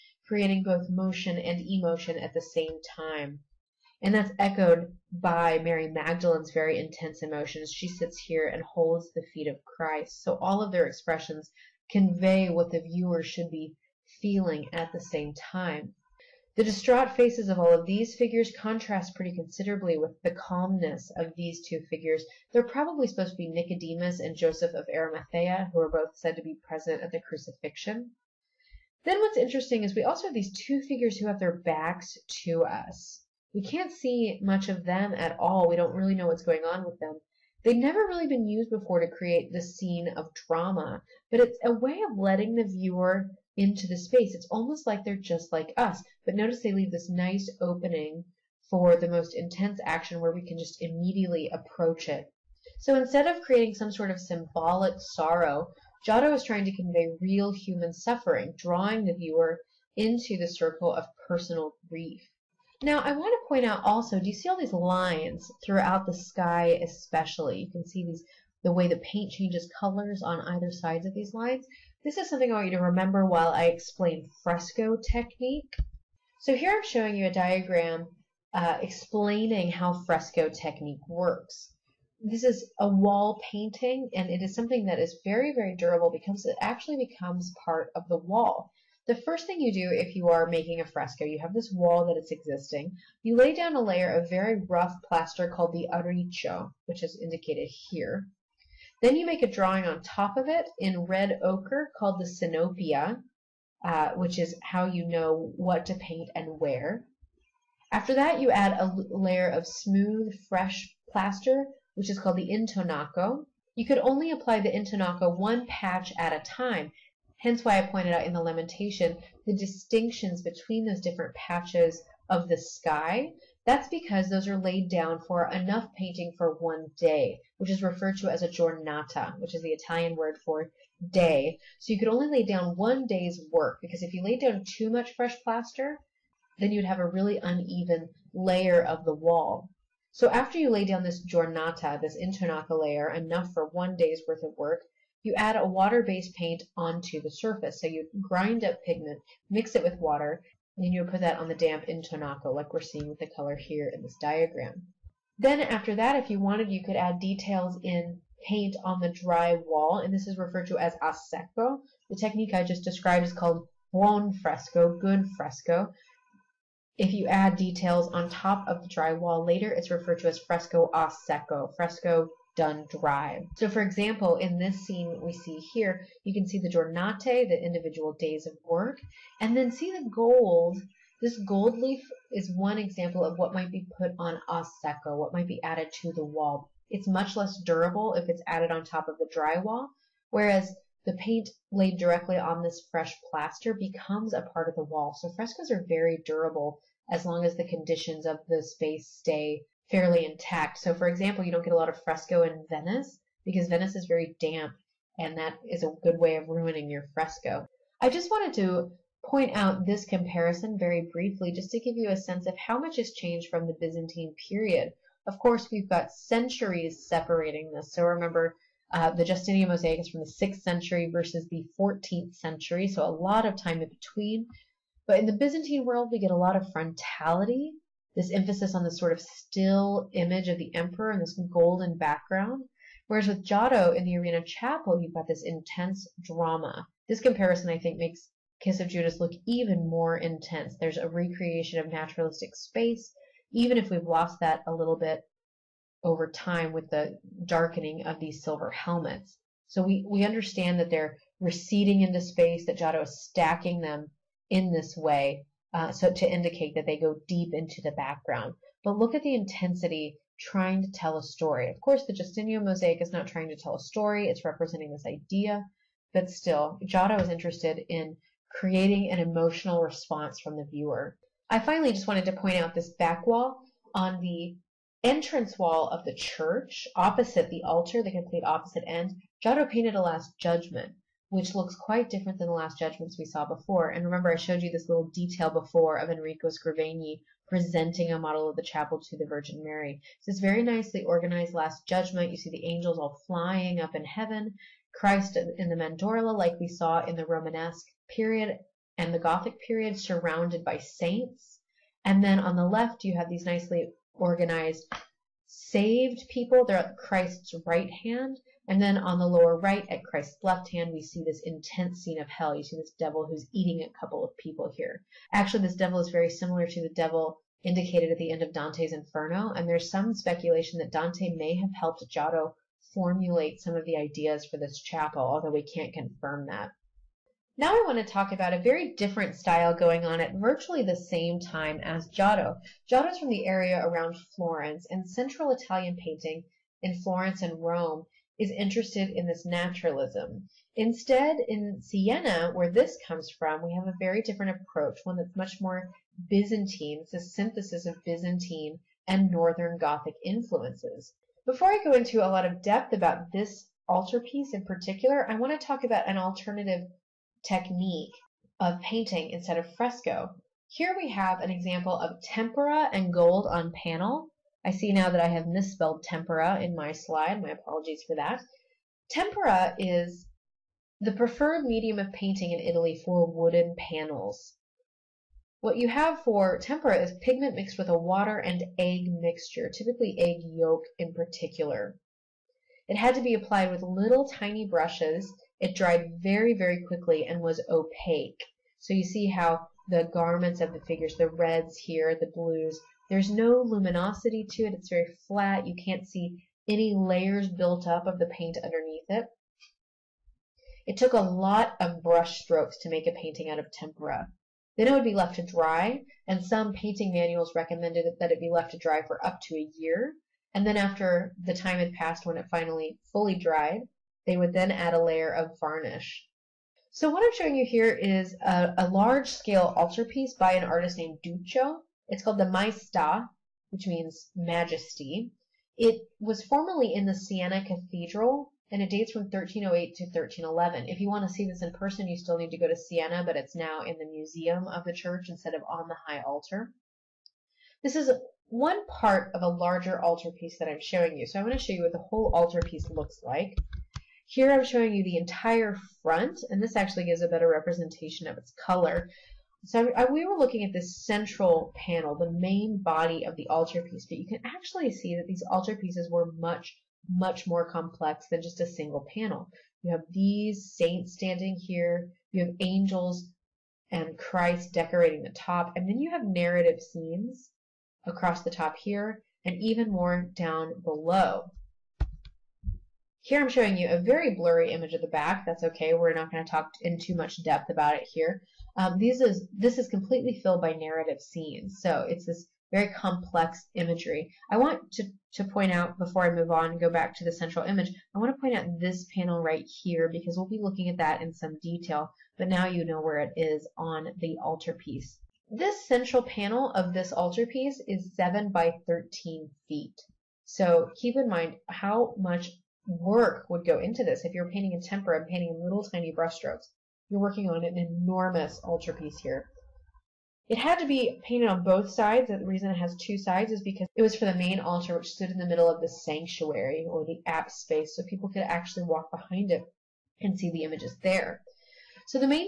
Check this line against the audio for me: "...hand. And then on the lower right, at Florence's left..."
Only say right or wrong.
wrong.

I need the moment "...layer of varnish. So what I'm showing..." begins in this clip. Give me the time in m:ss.
6:55.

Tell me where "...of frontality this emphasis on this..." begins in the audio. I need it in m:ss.
3:46.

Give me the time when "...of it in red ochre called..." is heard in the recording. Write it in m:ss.
1:40.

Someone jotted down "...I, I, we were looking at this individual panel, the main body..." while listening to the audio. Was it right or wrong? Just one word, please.
wrong.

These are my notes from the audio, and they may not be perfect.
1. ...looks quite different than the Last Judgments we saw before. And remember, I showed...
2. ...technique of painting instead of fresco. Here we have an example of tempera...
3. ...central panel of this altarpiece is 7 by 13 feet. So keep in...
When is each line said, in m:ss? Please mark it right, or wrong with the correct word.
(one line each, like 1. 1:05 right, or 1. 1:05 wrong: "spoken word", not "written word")
1. 4:41 right
2. 5:57 right
3. 8:15 right.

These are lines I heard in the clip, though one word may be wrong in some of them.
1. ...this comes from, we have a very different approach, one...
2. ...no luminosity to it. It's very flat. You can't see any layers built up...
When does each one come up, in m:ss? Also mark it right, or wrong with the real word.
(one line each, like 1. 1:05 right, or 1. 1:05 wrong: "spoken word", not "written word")
1. 5:42 right
2. 6:33 right.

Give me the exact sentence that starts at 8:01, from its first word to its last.
So it's this very complex imagery.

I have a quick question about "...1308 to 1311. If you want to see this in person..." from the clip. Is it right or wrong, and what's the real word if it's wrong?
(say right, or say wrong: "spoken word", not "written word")
right.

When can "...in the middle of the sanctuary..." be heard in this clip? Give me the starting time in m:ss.
8:35.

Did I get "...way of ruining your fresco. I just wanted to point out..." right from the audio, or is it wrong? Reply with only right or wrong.
right.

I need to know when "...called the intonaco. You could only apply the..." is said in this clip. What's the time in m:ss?
1:52.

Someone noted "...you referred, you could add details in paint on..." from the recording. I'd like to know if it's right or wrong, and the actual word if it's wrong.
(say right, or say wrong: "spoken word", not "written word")
wrong: "wanted", not "referred".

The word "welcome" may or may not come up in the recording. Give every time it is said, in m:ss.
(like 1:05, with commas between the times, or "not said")
not said.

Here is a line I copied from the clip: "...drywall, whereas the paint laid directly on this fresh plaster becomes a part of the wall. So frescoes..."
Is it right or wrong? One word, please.
right.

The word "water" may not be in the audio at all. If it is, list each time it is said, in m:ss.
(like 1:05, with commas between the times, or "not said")
2:25, 2:29, 6:17.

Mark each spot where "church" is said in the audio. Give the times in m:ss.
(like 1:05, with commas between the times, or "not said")
4:36, 7:14.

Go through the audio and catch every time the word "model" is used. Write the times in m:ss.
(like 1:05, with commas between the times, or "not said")
4:48.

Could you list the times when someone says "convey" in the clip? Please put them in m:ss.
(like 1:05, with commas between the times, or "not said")
0:11, 0:56.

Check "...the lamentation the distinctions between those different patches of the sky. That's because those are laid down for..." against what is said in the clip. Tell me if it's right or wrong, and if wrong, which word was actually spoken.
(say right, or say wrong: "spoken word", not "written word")
right.